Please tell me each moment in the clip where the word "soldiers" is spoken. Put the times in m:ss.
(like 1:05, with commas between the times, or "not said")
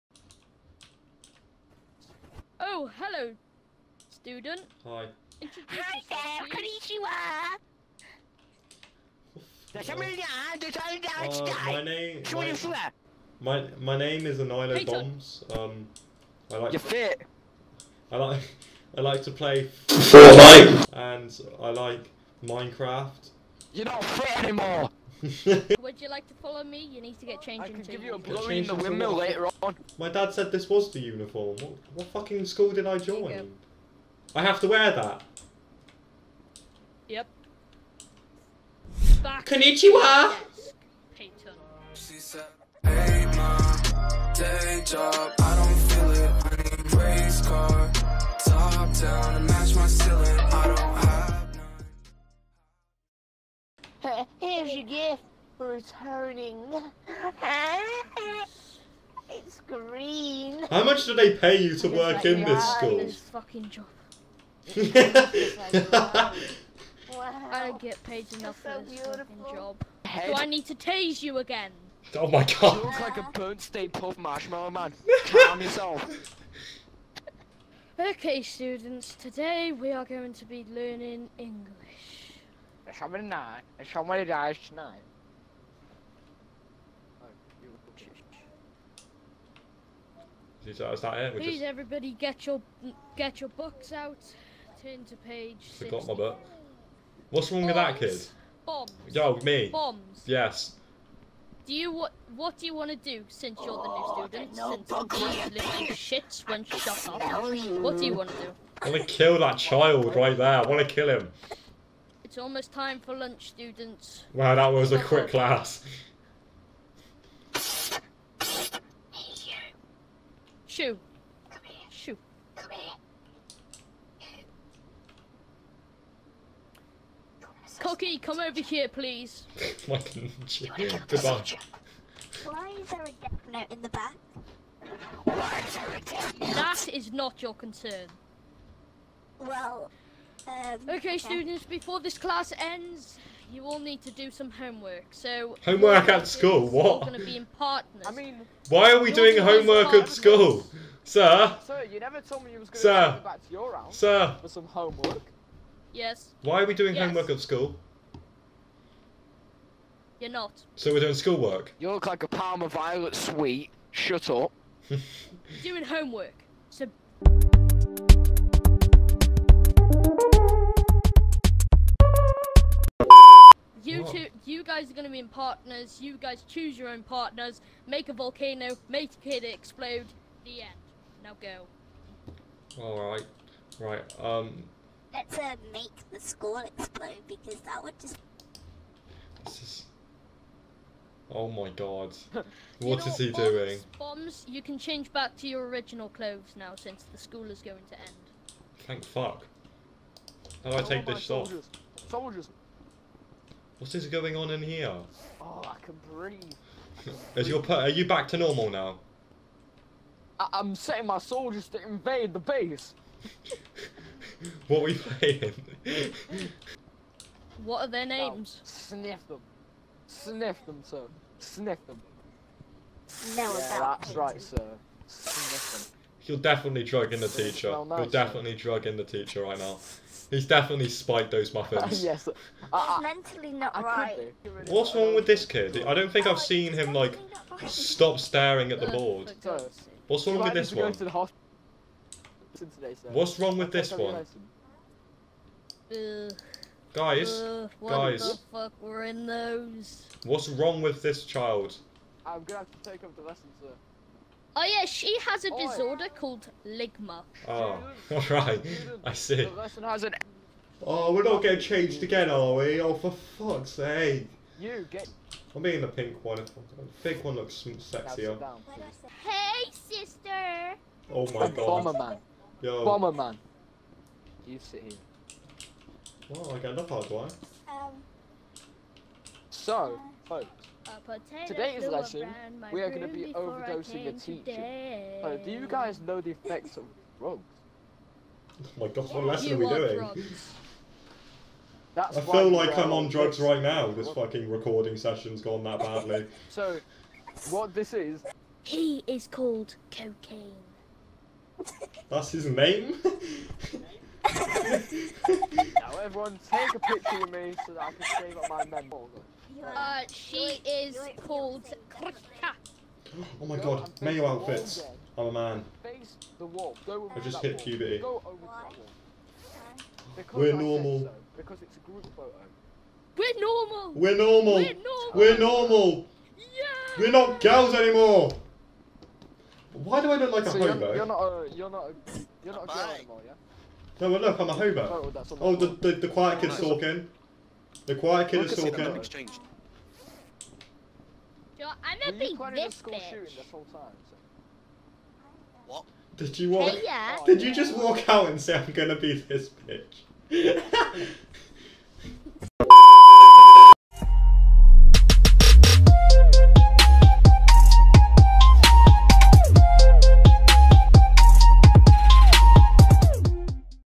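3:22, 3:31.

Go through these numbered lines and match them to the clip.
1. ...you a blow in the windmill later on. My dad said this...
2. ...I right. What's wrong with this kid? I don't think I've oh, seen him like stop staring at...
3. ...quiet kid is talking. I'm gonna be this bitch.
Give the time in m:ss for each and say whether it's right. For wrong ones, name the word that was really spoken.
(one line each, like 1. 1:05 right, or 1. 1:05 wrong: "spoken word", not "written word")
1. 0:28 right
2. 3:53 right
3. 5:37 right.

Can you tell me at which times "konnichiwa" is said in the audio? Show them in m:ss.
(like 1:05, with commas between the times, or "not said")
0:06, 0:39.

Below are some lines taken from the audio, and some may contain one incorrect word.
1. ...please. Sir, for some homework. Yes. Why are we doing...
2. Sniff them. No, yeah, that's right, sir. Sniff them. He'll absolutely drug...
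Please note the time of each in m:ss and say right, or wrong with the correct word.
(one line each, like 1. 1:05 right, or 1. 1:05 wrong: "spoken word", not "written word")
1. 2:33 wrong: "house", not "please"
2. 3:41 wrong: "definitely", not "absolutely".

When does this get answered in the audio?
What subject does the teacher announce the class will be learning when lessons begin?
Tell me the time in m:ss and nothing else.
1:21.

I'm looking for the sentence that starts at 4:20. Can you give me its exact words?
Oh, we're not getting changed again, are we?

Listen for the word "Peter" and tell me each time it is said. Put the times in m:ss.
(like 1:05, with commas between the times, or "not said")
0:14.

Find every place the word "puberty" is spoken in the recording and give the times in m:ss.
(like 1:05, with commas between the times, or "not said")
5:17.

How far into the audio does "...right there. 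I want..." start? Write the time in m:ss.
1:50.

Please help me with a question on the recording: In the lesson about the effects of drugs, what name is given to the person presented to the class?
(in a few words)
Cocaine.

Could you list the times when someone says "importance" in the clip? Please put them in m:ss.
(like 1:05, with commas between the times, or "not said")
not said.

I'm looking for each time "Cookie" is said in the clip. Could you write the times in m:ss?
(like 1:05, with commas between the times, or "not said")
2:07.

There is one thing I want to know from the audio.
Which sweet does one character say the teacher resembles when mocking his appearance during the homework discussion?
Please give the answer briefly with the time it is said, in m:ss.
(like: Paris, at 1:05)
Parma Violet, at 2:42.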